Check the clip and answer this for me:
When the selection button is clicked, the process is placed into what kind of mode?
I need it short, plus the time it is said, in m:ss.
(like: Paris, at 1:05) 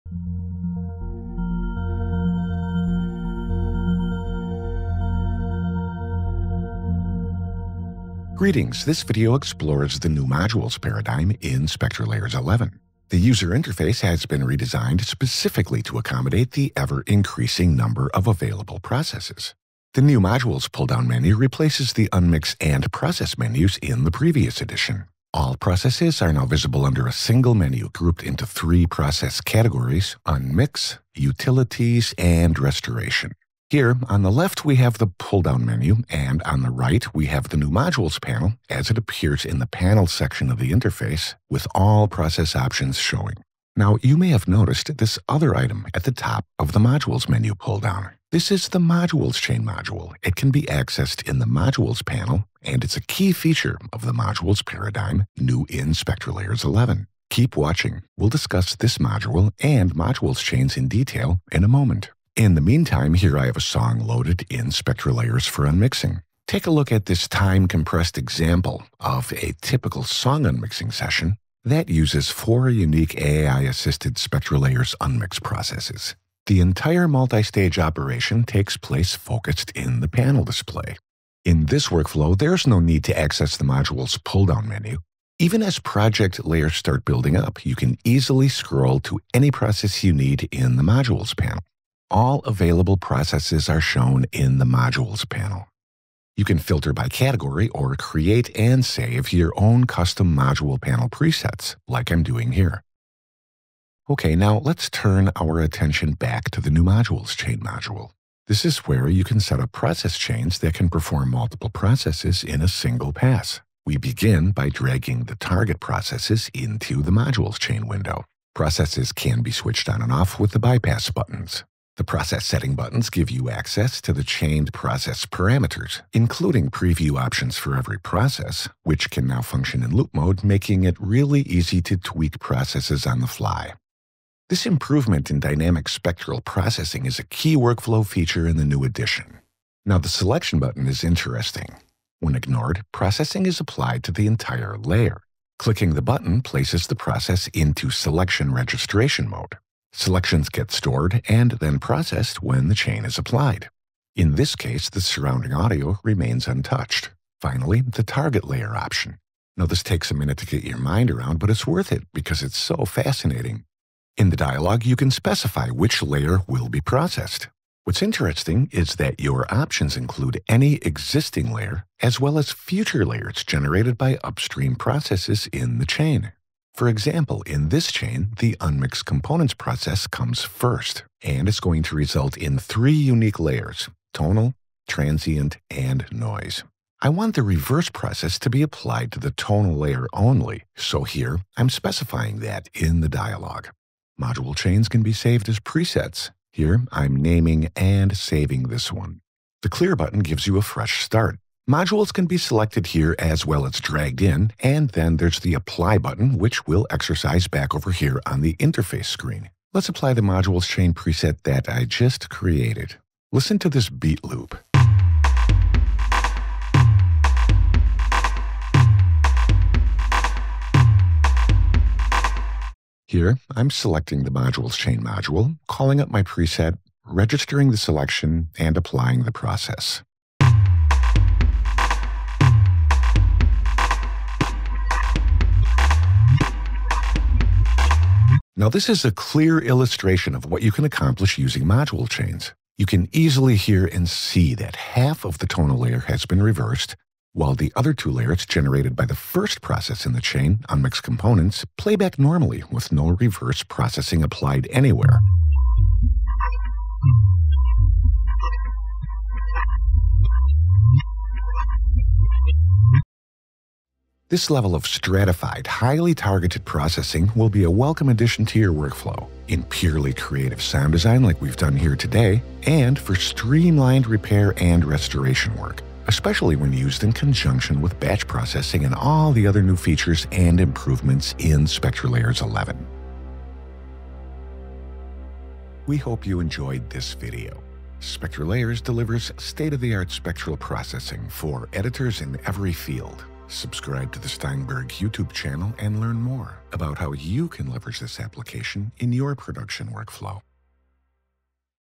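Selection registration mode, at 2:27.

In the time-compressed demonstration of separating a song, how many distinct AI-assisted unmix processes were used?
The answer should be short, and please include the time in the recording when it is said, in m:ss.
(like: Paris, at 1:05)
4, at 1:12.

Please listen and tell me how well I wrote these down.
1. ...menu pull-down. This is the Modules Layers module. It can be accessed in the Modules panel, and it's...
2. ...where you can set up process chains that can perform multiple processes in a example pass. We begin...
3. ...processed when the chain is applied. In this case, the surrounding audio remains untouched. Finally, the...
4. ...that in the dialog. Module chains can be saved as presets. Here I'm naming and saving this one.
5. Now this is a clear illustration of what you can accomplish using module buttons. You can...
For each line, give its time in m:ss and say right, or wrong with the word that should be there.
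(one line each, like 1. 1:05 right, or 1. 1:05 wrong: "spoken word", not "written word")
1. 0:47 wrong: "Chain", not "Layers"
2. 1:48 wrong: "single", not "example"
3. 2:31 right
4. 3:12 right
5. 3:58 wrong: "chains", not "buttons".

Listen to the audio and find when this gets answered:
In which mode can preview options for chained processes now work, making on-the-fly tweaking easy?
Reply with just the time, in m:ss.
2:09.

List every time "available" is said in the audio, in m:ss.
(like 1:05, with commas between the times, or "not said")
0:18, 1:32.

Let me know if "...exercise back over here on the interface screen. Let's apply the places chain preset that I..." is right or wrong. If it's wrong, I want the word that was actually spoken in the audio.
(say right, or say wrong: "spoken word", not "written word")
wrong: "modules", not "places".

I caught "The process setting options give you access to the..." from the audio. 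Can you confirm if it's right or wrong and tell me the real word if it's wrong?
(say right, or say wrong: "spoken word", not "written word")
wrong: "buttons", not "options".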